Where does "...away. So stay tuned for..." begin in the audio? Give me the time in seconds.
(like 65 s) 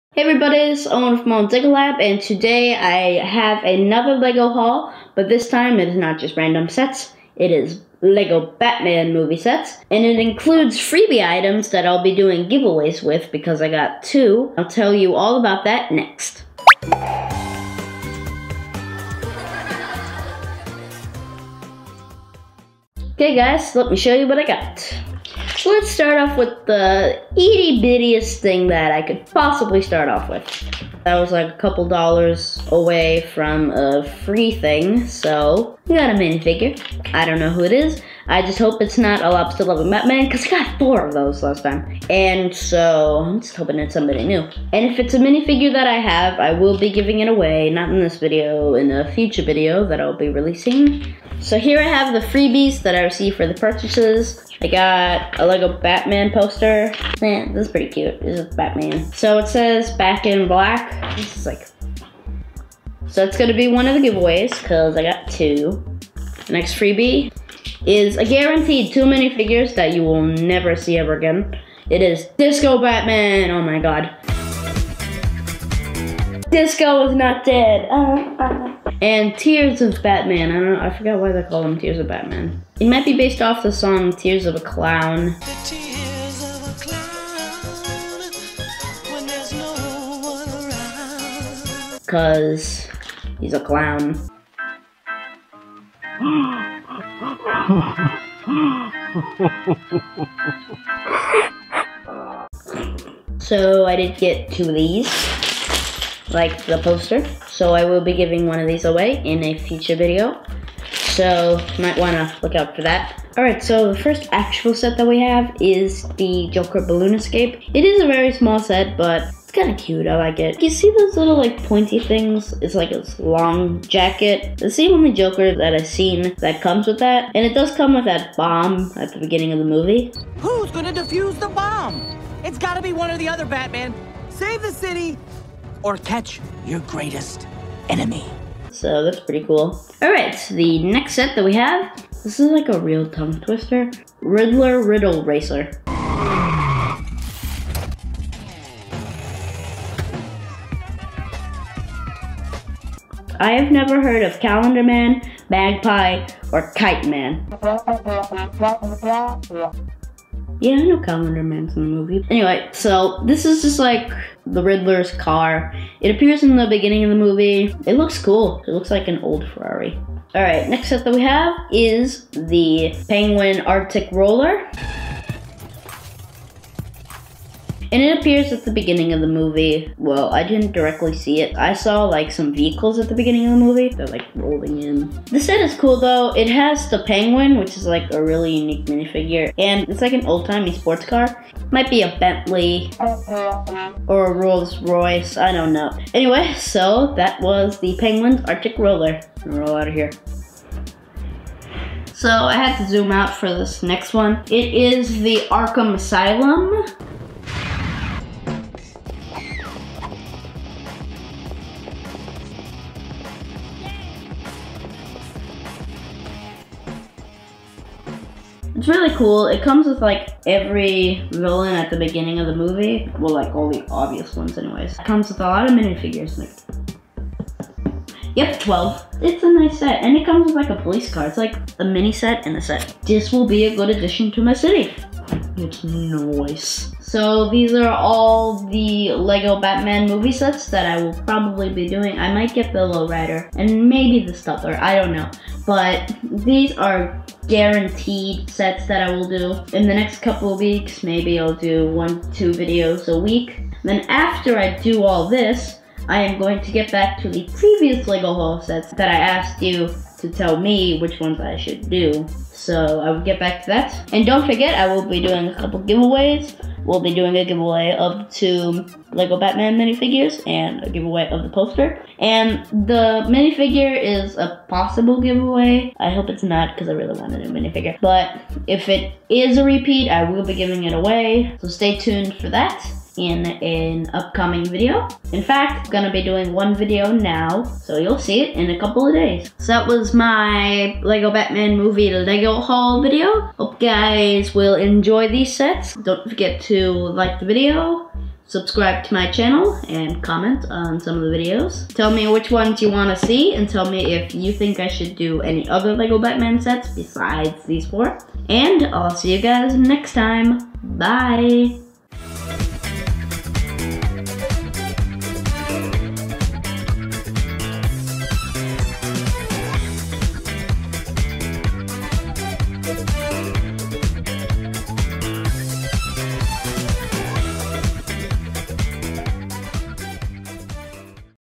280 s.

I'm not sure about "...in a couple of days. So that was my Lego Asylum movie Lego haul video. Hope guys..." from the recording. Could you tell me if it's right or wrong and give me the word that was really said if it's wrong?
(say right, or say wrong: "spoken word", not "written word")
wrong: "Batman", not "Asylum".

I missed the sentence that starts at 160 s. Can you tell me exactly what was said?
Yeah, I know Calendar Man's in the movie.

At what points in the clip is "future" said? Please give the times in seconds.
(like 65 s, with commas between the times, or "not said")
49 s, 109 s.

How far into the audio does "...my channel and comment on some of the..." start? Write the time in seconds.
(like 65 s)
299 s.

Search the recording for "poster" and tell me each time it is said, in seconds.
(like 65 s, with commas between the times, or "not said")
56 s, 106 s, 271 s.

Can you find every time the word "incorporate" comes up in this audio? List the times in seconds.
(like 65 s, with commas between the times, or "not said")
not said.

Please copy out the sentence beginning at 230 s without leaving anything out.
And it comes with like a police car.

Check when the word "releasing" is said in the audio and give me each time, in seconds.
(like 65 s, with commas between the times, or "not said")
50 s.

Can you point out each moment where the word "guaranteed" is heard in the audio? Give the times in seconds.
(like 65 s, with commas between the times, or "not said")
68 s, 247 s.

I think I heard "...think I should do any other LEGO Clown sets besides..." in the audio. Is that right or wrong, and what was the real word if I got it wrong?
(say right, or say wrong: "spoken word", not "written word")
wrong: "Batman", not "Clown".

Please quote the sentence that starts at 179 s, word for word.
Well, I didn't directly see it.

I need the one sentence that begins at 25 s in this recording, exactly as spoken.
So let's start off with the itty bittiest thing that I could possibly start off with.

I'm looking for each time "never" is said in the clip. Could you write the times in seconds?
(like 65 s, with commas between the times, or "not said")
70 s, 153 s.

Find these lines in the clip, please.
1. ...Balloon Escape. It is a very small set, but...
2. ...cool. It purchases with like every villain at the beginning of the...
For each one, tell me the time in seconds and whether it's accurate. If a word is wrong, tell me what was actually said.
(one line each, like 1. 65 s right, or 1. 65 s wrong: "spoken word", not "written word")
1. 116 s right
2. 219 s wrong: "comes", not "purchases".